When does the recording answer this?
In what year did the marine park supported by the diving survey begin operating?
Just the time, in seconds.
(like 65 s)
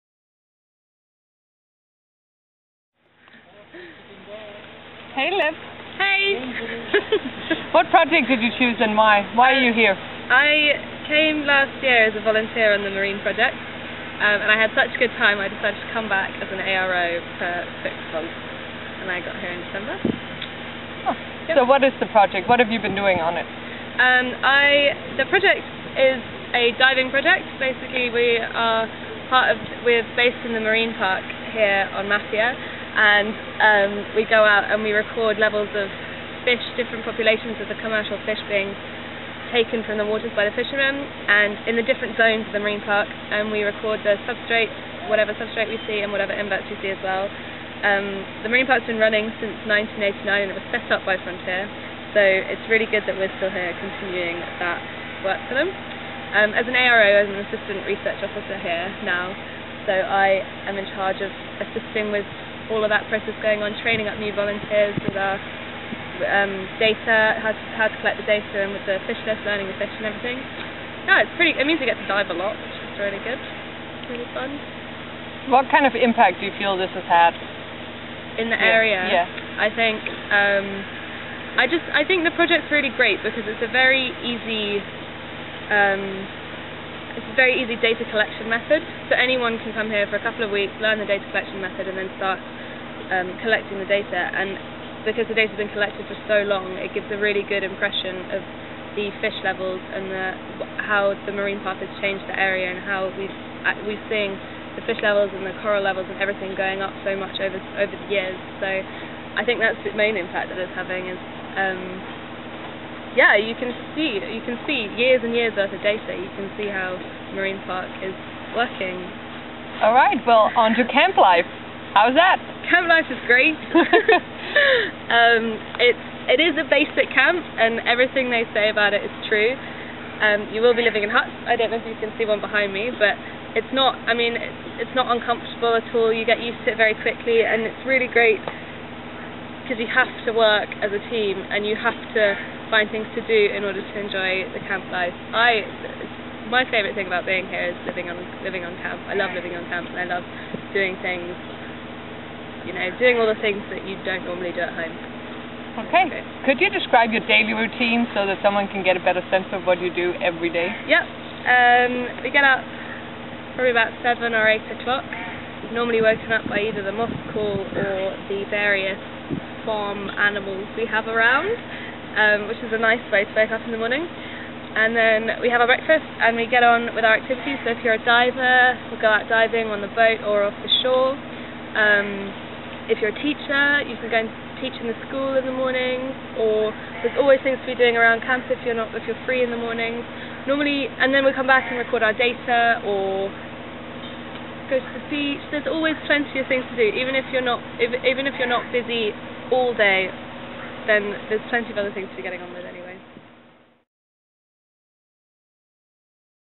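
49 s.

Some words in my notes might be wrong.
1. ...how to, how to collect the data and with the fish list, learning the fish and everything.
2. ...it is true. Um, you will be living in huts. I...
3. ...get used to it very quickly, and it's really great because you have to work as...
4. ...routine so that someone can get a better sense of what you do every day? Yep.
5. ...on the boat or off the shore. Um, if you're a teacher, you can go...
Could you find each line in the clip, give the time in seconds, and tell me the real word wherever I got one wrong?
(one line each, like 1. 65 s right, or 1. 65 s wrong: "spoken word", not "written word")
1. 67 s right
2. 128 s right
3. 136 s right
4. 157 s right
5. 179 s right.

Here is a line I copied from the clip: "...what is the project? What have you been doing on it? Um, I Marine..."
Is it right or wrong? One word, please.
wrong.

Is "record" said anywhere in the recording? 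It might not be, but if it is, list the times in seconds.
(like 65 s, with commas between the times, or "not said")
34 s, 43 s, 191 s.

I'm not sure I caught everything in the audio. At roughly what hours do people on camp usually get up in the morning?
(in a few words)
7 or 8 o'clock.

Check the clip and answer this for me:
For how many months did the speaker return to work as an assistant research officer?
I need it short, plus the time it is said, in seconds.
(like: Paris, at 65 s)
6, at 17 s.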